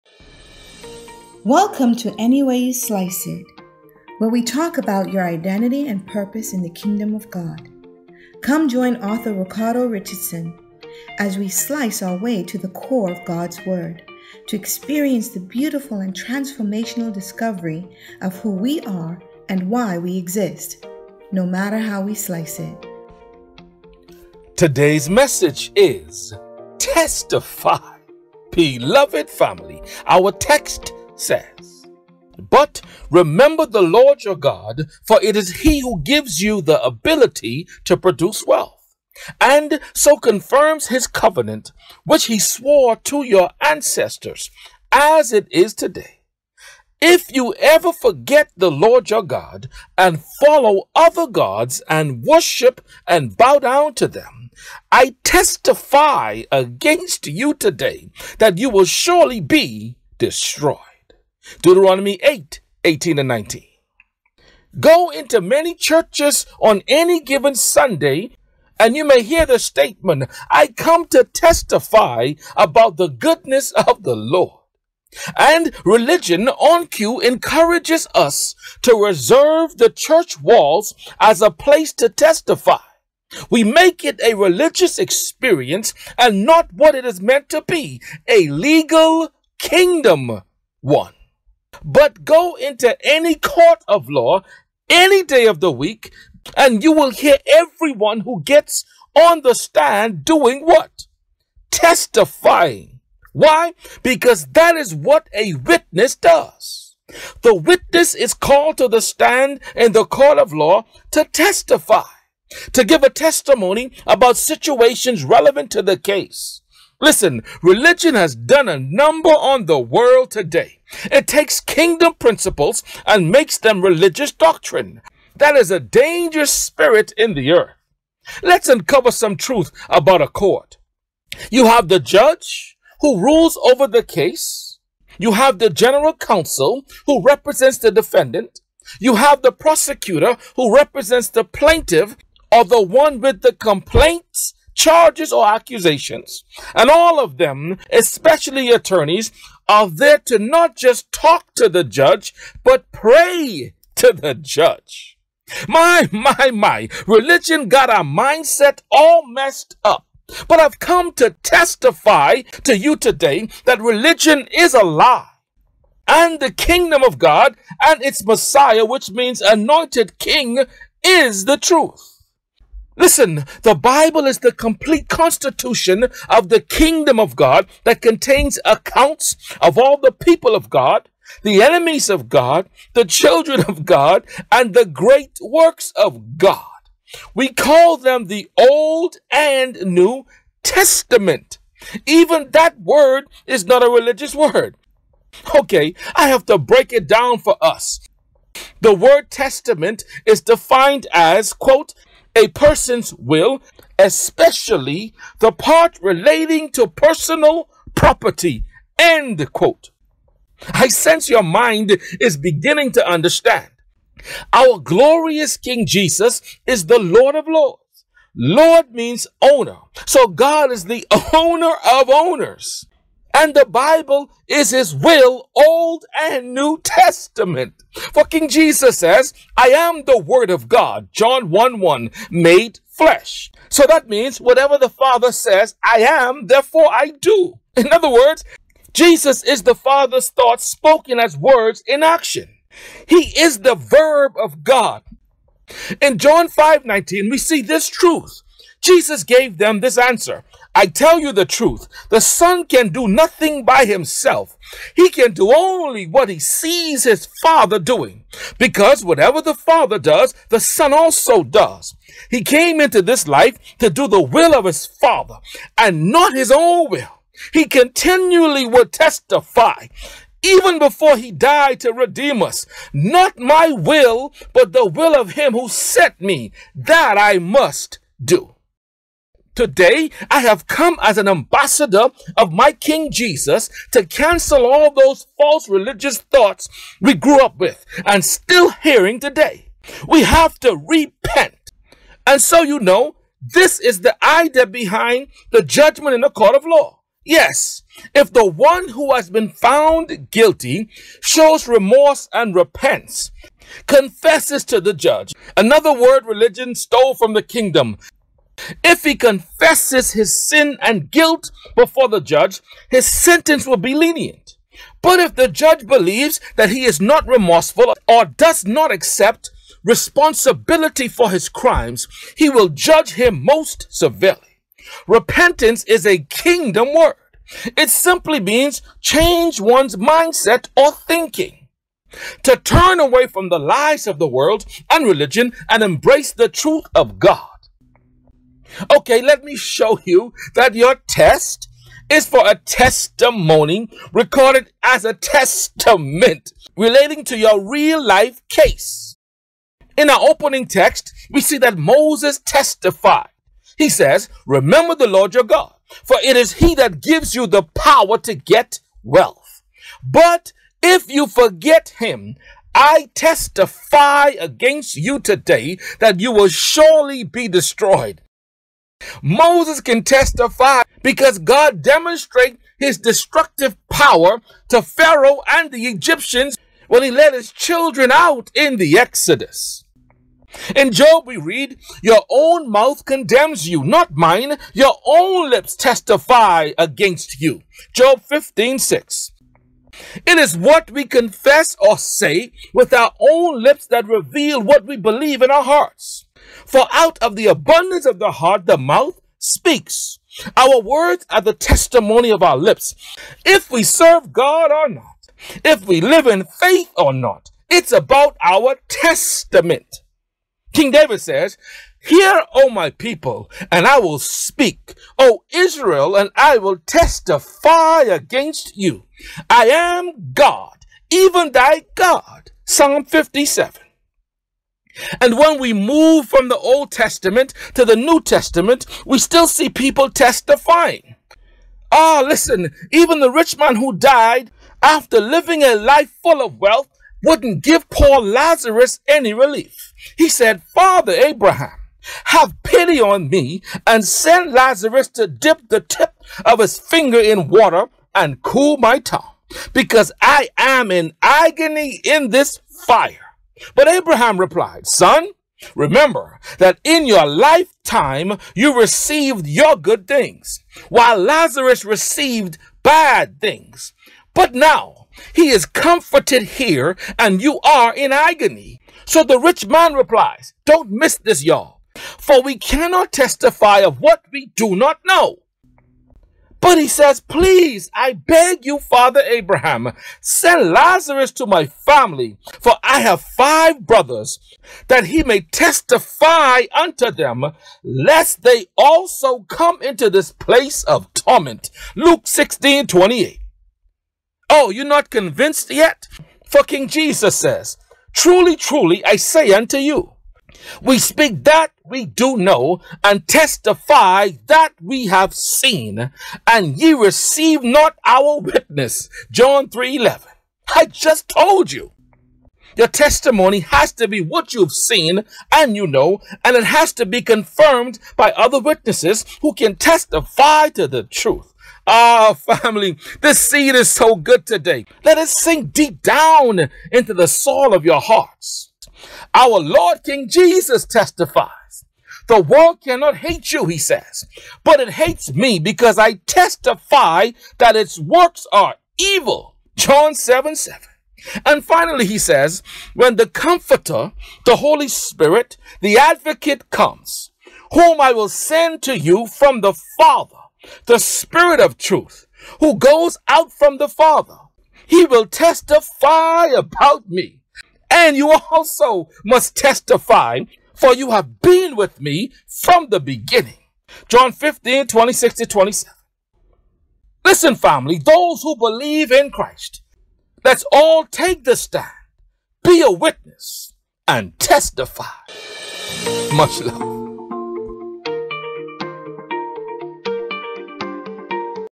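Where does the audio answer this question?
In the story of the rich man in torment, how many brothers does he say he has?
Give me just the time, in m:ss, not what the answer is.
8:03.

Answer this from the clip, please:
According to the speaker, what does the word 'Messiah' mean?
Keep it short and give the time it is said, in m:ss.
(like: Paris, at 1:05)
Anointed king, at 2:49.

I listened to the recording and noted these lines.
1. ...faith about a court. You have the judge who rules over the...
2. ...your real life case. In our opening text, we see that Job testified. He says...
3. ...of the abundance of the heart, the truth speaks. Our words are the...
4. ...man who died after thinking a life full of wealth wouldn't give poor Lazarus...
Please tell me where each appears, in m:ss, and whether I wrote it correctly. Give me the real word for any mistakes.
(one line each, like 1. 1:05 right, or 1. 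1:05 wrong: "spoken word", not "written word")
1. 2:09 wrong: "truth", not "faith"
2. 5:47 wrong: "Moses", not "Job"
3. 6:37 wrong: "mouth", not "truth"
4. 7:13 wrong: "living", not "thinking".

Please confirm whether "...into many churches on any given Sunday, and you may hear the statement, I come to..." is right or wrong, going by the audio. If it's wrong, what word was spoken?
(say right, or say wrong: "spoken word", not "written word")
right.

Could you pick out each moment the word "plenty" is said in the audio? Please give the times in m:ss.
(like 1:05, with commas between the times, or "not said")
not said.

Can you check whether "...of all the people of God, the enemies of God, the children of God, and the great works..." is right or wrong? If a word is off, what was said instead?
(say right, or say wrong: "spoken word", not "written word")
right.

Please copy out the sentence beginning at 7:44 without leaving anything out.
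But now he is comforted here and you are in agony.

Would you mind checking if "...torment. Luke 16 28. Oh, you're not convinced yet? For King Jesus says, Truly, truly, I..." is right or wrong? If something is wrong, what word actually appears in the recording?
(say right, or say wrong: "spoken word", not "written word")
right.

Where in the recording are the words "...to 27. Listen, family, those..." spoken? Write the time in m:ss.
9:25.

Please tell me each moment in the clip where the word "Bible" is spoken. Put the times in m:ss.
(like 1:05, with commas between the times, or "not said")
2:53, 3:43.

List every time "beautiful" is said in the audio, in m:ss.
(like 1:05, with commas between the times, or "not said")
0:15.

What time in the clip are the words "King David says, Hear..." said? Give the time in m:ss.
6:50.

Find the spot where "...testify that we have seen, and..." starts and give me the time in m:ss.
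8:23.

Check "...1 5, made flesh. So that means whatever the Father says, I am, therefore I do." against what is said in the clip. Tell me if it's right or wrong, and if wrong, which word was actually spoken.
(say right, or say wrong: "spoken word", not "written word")
wrong: "1", not "5".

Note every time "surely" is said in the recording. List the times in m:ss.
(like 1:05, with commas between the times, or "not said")
0:58, 6:06.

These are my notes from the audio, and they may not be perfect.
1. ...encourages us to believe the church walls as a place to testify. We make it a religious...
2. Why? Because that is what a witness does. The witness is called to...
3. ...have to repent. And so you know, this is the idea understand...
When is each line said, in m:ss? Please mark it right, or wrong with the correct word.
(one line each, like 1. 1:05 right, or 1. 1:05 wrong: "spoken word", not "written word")
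1. 1:17 wrong: "reserve", not "believe"
2. 1:43 right
3. 4:50 wrong: "behind", not "understand".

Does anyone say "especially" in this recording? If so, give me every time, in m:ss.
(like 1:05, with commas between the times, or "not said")
2:27, 3:23.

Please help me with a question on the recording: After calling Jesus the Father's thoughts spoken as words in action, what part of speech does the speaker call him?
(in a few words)
The verb of God.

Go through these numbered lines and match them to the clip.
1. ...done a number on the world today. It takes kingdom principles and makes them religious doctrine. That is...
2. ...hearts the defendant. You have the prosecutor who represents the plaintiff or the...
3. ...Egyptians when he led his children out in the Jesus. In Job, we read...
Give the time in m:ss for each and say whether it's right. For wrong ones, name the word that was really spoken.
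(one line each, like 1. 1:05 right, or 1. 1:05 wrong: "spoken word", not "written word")
1. 1:58 right
2. 2:17 wrong: "represents", not "hearts"
3. 6:15 wrong: "Exodus", not "Jesus".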